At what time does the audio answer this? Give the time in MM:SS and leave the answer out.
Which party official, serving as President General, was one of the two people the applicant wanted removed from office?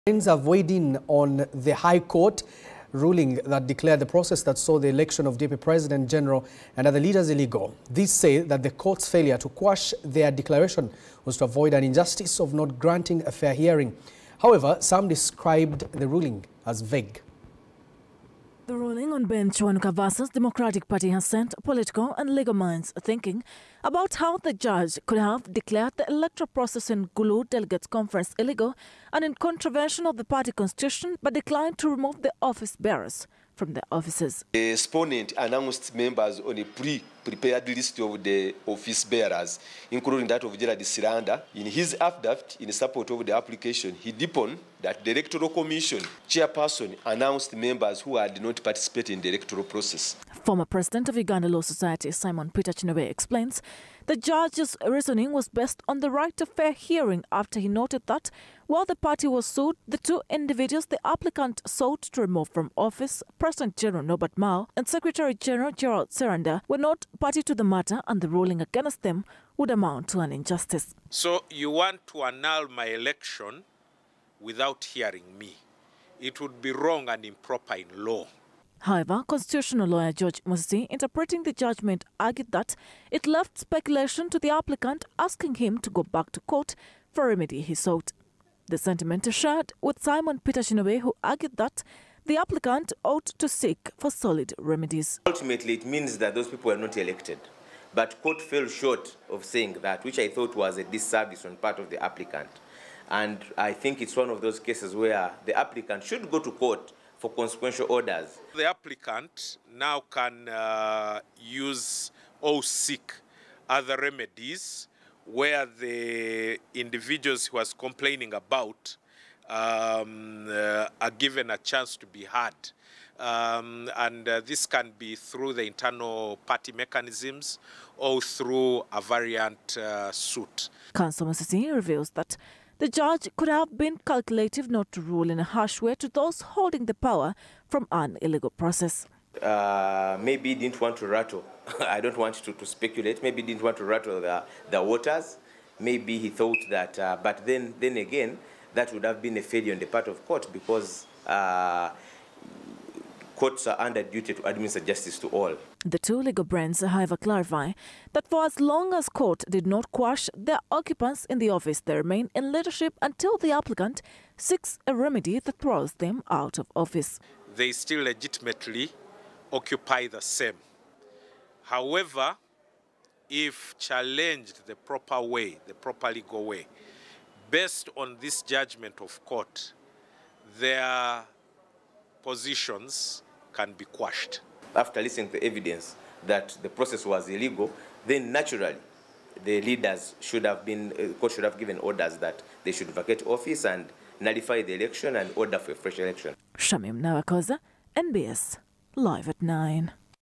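01:04.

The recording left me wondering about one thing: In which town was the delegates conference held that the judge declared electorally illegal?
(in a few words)
Gulu.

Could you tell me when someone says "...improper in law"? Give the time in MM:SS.
01:17.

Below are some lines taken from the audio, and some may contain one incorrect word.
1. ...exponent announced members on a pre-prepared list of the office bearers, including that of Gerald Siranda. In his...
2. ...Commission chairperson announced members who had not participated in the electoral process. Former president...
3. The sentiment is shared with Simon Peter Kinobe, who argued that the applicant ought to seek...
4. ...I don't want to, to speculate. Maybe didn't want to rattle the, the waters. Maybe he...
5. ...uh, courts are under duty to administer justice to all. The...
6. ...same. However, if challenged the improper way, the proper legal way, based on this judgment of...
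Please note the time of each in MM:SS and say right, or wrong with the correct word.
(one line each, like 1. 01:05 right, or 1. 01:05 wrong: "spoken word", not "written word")
1. 00:34 right
2. 00:45 right
3. 01:28 right
4. 02:21 right
5. 02:31 right
6. 02:50 wrong: "proper", not "improper".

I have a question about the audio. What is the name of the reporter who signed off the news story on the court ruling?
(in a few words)
Shamim Nabakooza.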